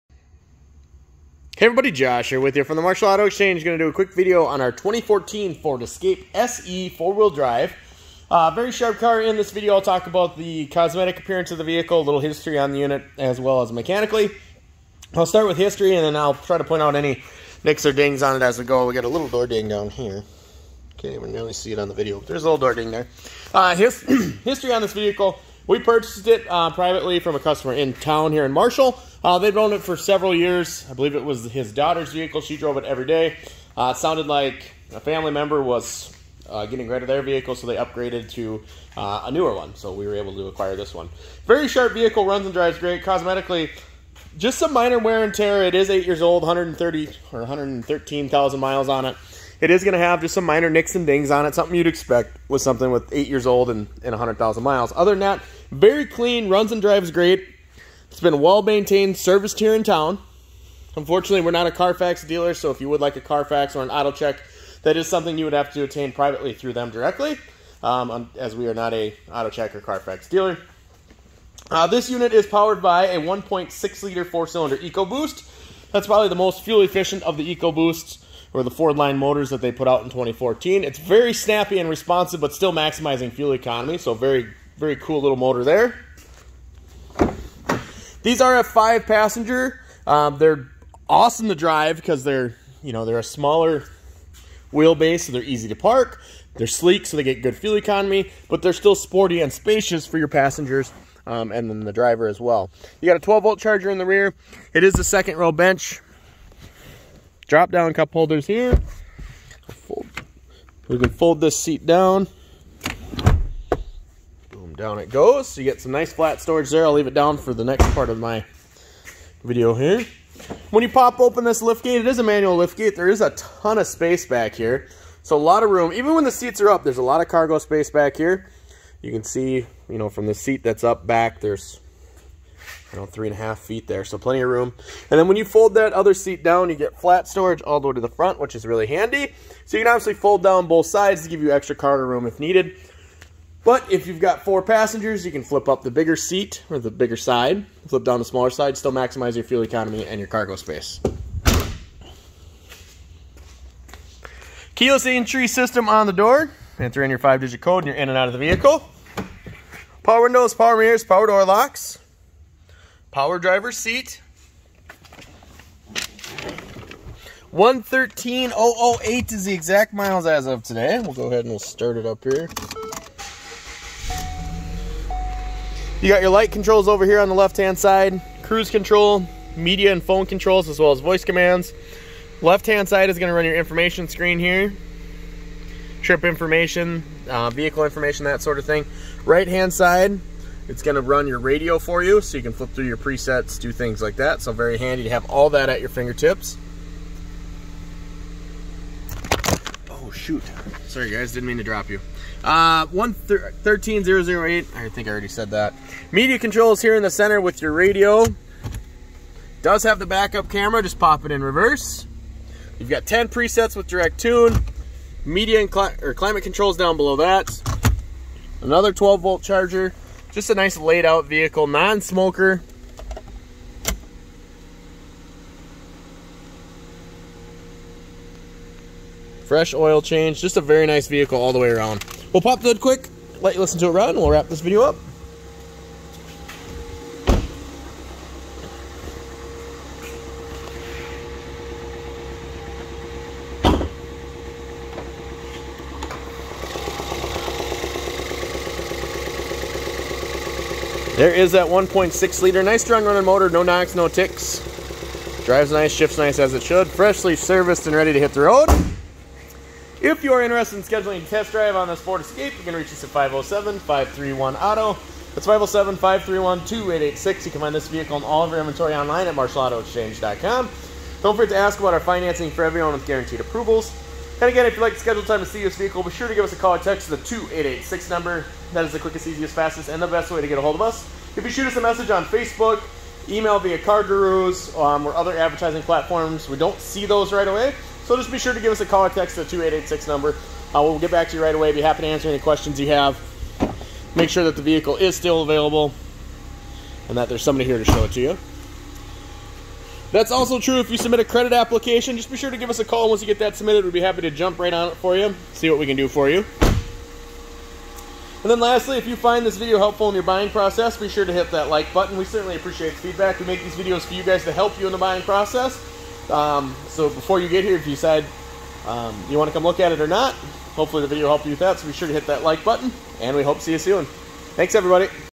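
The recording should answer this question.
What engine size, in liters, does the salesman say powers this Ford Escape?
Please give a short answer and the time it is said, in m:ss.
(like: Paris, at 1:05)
1.6 liter, at 1:13.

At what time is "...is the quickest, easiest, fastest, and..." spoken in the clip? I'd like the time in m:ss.
4:38.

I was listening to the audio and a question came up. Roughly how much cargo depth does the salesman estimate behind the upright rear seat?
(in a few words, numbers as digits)
3.5 feet.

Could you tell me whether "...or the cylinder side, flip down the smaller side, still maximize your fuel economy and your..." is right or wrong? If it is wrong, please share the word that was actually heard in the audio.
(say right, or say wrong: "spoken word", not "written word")
wrong: "bigger", not "cylinder".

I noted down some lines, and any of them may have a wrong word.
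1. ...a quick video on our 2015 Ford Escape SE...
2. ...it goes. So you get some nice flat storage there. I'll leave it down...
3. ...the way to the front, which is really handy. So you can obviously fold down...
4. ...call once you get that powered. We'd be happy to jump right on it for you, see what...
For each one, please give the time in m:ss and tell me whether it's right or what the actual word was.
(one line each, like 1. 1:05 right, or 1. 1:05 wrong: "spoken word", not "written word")
1. 0:03 wrong: "2014", not "2015"
2. 1:54 right
3. 2:17 right
4. 5:02 wrong: "submitted", not "powered".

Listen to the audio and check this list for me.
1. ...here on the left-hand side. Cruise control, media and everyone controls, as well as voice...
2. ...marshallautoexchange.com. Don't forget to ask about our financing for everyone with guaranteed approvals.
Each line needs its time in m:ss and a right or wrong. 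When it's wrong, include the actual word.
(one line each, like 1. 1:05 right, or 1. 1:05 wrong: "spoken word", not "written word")
1. 2:57 wrong: "phone", not "everyone"
2. 4:29 right.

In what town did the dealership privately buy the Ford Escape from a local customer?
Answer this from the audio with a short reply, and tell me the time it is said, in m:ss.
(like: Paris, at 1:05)
Marshall, at 0:28.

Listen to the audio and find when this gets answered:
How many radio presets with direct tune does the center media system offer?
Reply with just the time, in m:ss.
3:33.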